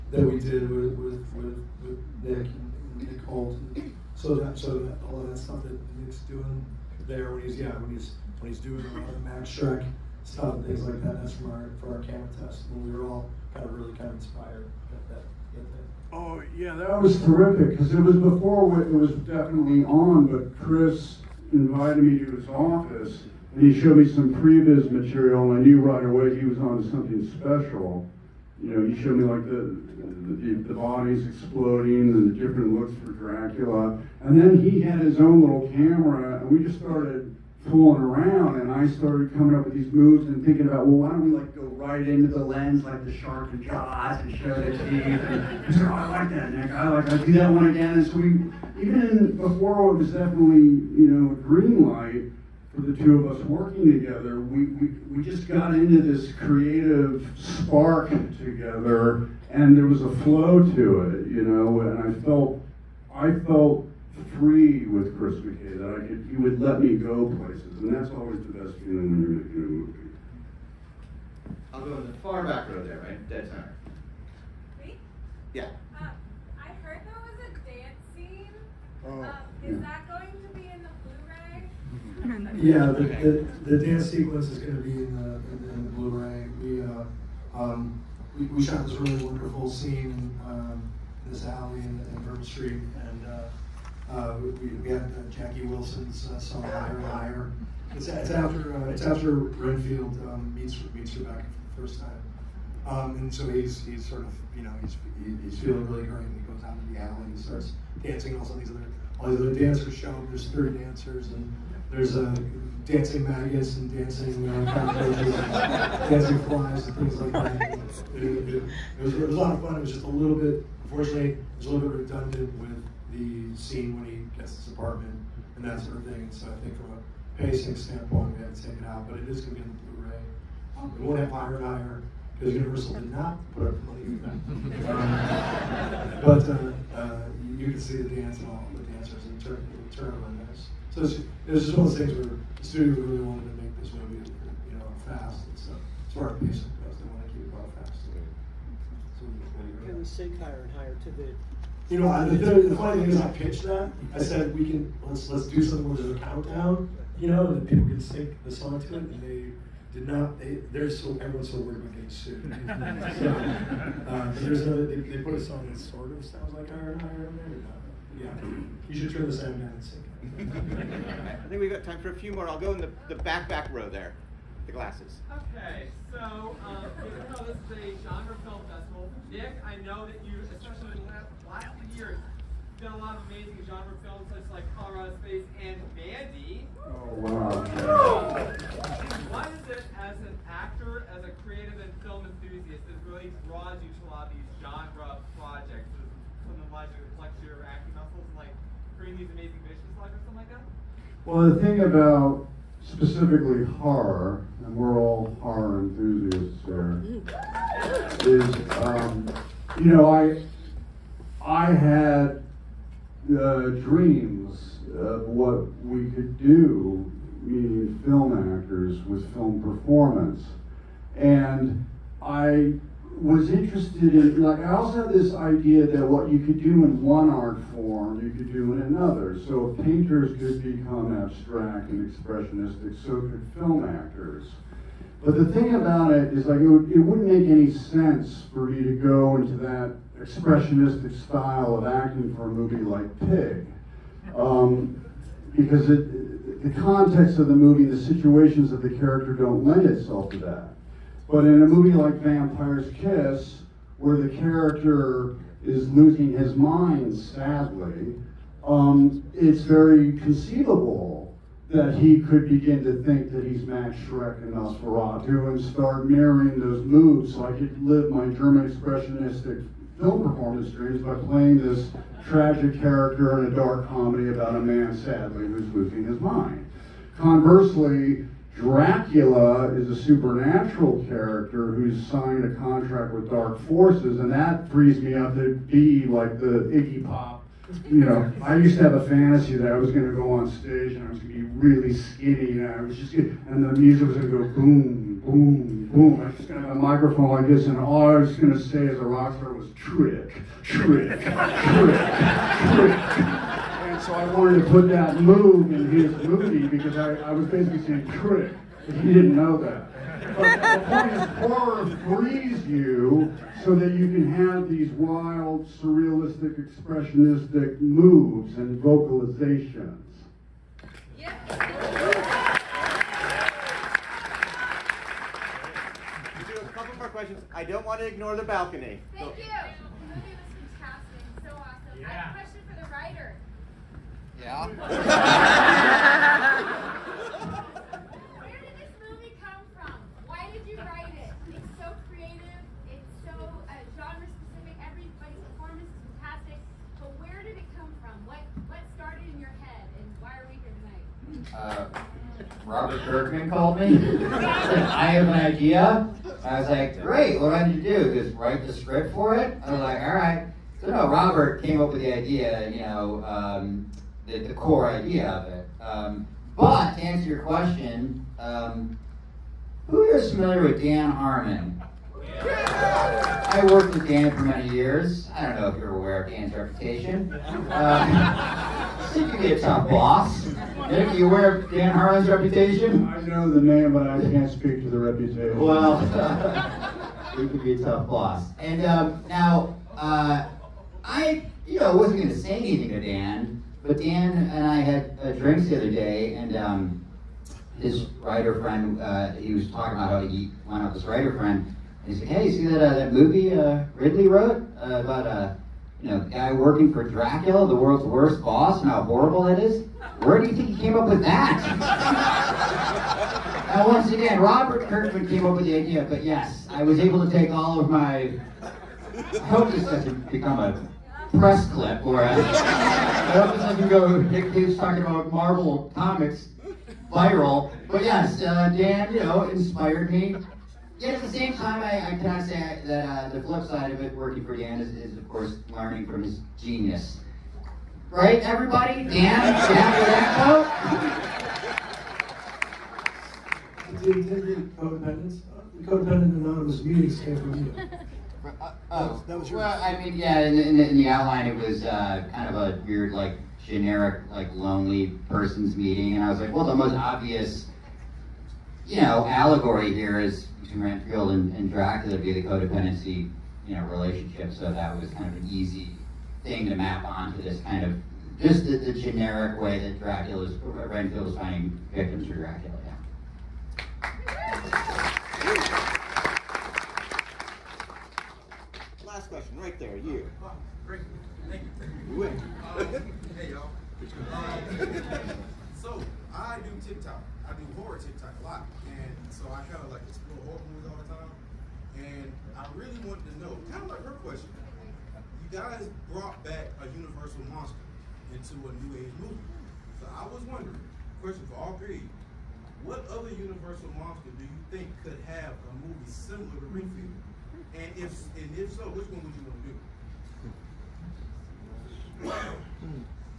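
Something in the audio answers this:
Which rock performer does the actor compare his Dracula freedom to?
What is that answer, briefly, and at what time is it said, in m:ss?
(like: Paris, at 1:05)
Iggy Pop, at 4:46.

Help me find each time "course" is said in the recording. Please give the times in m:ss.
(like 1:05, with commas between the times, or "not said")
7:15.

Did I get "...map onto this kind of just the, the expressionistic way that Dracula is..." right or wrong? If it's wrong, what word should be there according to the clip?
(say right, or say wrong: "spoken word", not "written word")
wrong: "generic", not "expressionistic".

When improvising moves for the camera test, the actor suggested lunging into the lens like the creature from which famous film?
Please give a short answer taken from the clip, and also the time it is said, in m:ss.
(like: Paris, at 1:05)
Jaws, at 0:43.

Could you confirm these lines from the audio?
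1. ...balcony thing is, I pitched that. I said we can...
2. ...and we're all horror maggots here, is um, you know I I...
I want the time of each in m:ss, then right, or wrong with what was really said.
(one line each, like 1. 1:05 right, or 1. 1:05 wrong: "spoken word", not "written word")
1. 2:32 wrong: "funny", not "balcony"
2. 3:24 wrong: "enthusiasts", not "maggots".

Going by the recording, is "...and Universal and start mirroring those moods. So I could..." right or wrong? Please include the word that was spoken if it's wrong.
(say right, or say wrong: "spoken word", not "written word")
wrong: "Nosferatu", not "Universal".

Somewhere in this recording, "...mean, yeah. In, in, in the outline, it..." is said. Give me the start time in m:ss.
7:29.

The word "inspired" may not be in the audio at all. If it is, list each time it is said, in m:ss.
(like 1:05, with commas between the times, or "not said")
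0:14, 7:09.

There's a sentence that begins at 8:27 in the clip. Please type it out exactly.
And if and if so, which one would you want to do?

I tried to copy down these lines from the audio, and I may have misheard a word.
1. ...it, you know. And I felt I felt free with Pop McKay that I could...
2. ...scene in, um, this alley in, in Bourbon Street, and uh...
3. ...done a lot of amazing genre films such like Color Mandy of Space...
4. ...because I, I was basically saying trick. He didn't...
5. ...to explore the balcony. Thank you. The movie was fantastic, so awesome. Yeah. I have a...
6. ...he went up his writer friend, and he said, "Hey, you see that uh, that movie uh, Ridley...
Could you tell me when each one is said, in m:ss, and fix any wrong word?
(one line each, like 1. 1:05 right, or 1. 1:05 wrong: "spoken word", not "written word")
1. 1:01 wrong: "Chris", not "Pop"
2. 1:29 right
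3. 3:02 wrong: "Out", not "Mandy"
4. 5:06 right
5. 5:28 wrong: "ignore", not "explore"
6. 6:40 right.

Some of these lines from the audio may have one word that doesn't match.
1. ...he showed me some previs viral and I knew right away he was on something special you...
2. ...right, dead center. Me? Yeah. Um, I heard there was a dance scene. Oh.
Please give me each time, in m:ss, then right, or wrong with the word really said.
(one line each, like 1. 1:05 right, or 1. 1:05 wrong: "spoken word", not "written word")
1. 0:23 wrong: "material", not "viral"
2. 1:12 right.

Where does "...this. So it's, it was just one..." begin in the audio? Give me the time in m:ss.
2:20.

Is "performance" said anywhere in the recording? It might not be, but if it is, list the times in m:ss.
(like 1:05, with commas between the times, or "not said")
3:39, 4:30, 5:45.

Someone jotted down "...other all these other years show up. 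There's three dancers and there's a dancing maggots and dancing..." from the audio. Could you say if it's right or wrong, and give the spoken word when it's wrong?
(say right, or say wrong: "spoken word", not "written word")
wrong: "dancers", not "years".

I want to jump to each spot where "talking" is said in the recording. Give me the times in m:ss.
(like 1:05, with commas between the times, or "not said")
6:39, 7:04.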